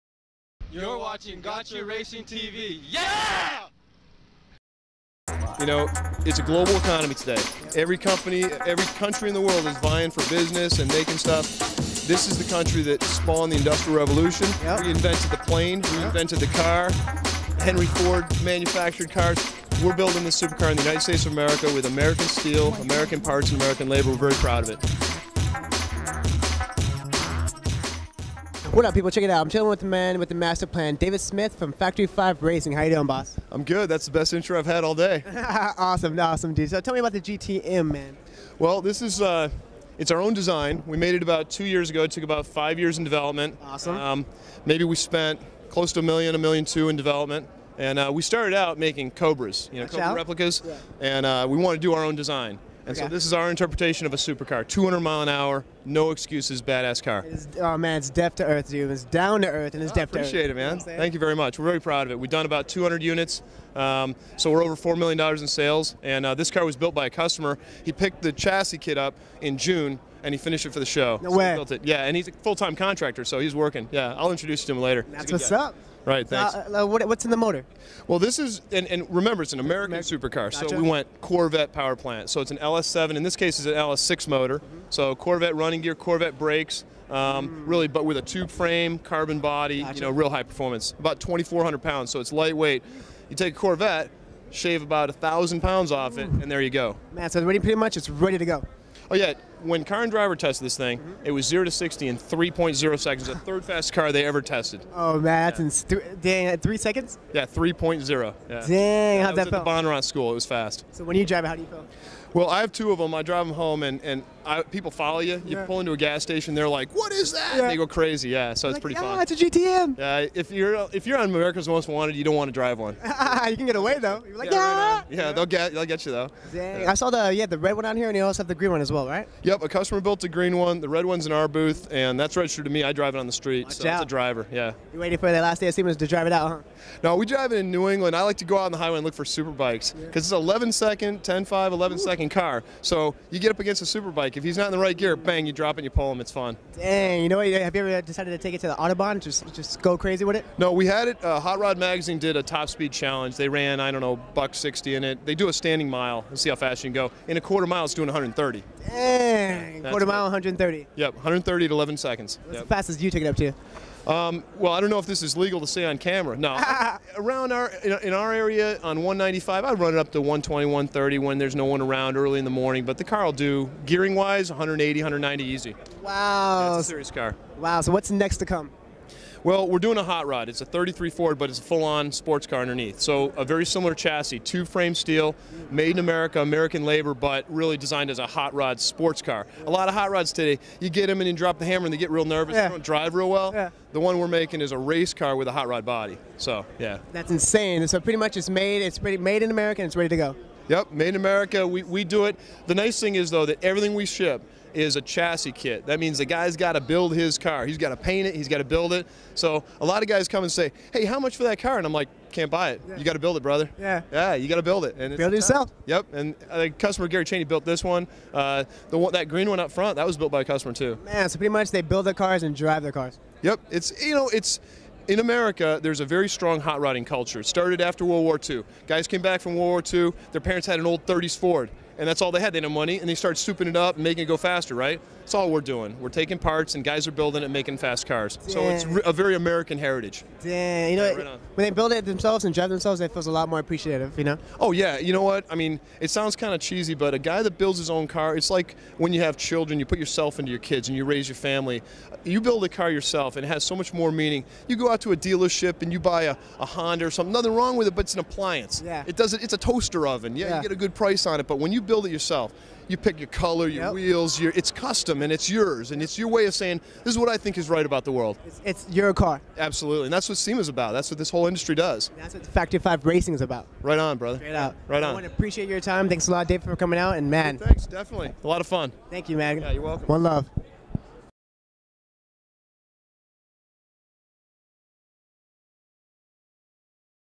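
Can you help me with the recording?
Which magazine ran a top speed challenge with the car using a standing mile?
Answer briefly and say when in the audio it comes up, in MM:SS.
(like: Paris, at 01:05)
Hot Rod Magazine, at 02:31.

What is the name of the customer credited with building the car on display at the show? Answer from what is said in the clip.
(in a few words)
Gary Cheney.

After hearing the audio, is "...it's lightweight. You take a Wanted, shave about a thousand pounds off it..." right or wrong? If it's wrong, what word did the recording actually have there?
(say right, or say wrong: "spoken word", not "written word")
wrong: "Corvette", not "Wanted".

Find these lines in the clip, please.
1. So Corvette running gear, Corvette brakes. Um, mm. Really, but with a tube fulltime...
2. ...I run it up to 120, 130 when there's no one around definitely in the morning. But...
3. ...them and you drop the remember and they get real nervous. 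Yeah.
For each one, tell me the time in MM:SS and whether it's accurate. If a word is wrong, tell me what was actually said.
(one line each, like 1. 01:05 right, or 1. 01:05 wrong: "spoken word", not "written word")
1. 01:24 wrong: "frame", not "fulltime"
2. 02:49 wrong: "early", not "definitely"
3. 03:11 wrong: "hammer", not "remember".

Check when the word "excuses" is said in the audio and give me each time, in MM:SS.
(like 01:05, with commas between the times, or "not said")
00:56.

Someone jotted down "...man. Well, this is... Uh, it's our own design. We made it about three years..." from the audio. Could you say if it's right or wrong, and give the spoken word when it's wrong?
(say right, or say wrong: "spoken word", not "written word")
wrong: "two", not "three".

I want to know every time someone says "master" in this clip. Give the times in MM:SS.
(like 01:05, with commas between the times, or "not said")
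00:30.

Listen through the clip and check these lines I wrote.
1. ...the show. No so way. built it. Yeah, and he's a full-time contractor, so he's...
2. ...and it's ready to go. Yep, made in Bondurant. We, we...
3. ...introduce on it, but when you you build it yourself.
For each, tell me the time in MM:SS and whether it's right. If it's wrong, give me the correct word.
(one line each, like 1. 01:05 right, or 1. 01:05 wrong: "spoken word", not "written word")
1. 01:10 right
2. 03:19 wrong: "America", not "Bondurant"
3. 04:20 wrong: "price", not "introduce".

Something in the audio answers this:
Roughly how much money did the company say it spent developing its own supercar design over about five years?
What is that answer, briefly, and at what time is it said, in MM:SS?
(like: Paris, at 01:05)
$1.2 million, at 00:46.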